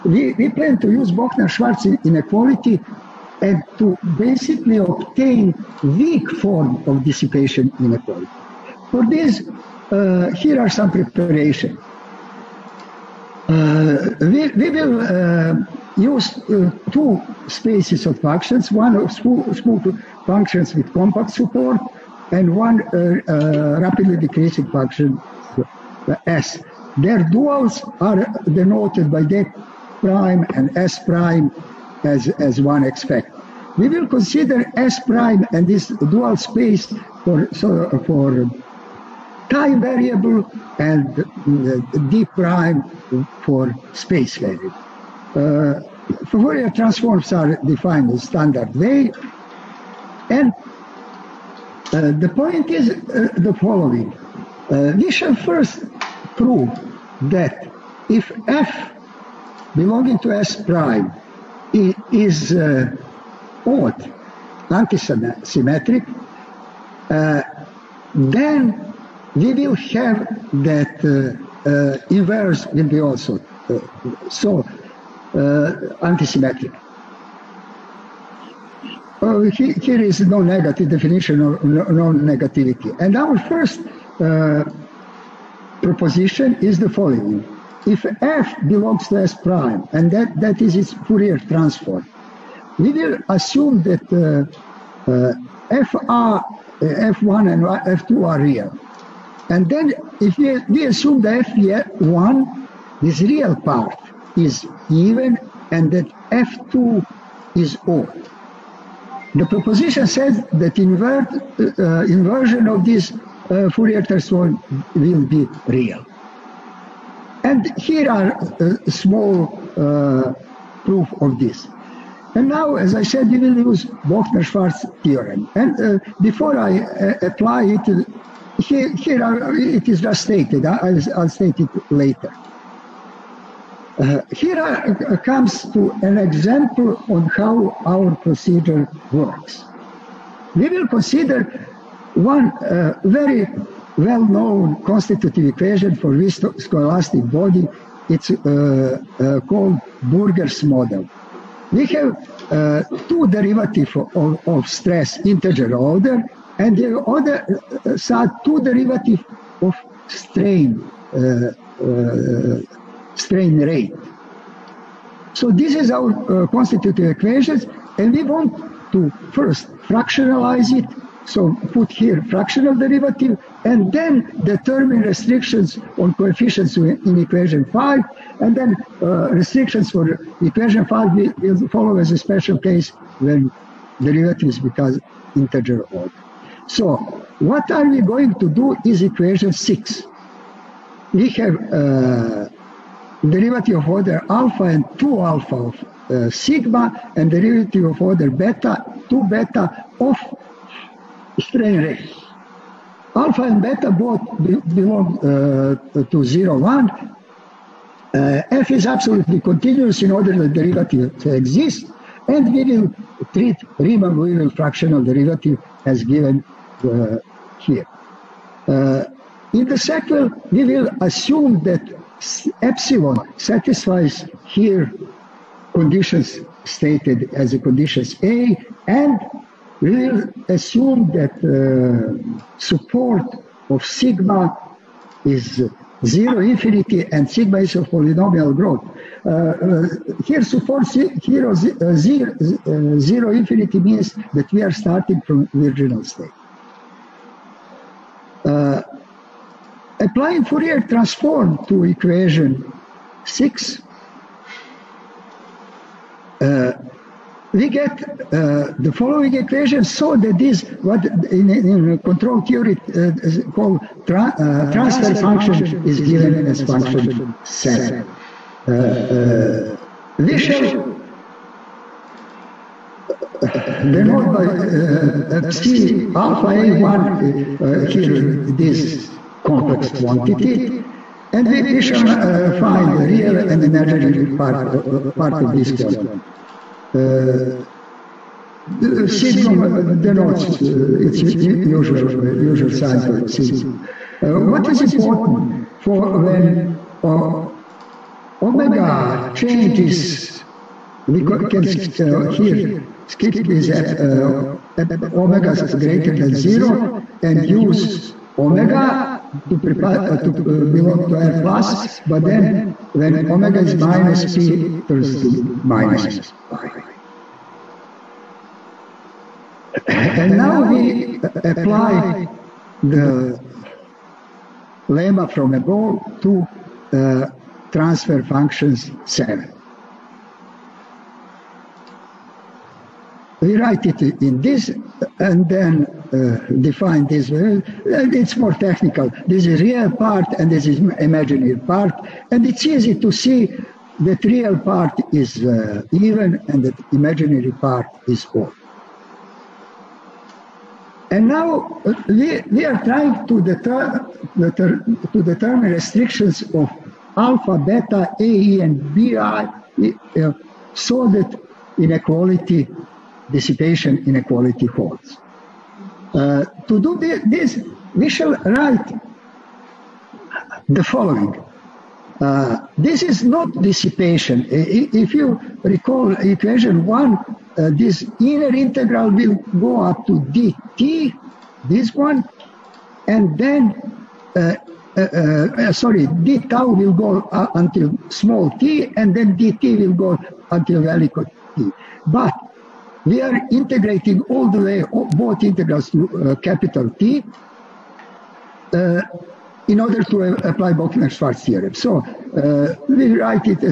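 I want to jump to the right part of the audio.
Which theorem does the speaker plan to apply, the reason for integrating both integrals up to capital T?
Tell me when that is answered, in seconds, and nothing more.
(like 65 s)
400 s.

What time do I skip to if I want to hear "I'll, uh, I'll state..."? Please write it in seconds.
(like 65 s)
130 s.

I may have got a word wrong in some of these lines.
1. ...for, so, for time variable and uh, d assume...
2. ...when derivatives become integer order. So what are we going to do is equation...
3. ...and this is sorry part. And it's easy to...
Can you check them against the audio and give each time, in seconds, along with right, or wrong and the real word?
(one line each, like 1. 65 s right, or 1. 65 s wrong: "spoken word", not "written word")
1. 37 s wrong: "prime", not "assume"
2. 183 s right
3. 340 s wrong: "imaginary", not "sorry".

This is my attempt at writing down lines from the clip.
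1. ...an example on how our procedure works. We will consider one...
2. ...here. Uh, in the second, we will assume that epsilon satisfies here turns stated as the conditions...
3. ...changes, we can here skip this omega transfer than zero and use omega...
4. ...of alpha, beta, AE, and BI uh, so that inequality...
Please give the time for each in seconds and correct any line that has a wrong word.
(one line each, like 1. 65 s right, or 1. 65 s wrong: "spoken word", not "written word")
1. 136 s right
2. 217 s wrong: "conditions", not "turns"
3. 299 s wrong: "greater", not "transfer"
4. 356 s right.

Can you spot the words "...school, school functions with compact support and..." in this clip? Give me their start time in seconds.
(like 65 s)
19 s.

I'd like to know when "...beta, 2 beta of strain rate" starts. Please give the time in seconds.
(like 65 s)
198 s.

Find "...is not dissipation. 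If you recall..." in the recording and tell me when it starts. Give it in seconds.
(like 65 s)
373 s.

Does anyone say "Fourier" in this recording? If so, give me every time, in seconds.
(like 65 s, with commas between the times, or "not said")
46 s, 90 s, 113 s, 250 s.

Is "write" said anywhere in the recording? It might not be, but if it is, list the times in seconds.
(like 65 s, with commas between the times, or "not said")
333 s, 368 s, 403 s.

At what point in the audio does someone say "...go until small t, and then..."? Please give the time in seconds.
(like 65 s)
386 s.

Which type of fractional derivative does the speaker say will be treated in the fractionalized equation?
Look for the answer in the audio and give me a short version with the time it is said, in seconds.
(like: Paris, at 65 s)
Riemann-Weyl, at 213 s.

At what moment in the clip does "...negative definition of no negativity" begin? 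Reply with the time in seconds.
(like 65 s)
80 s.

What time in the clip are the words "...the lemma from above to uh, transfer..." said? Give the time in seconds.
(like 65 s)
322 s.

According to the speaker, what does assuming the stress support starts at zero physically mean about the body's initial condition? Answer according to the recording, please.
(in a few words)
virginal state.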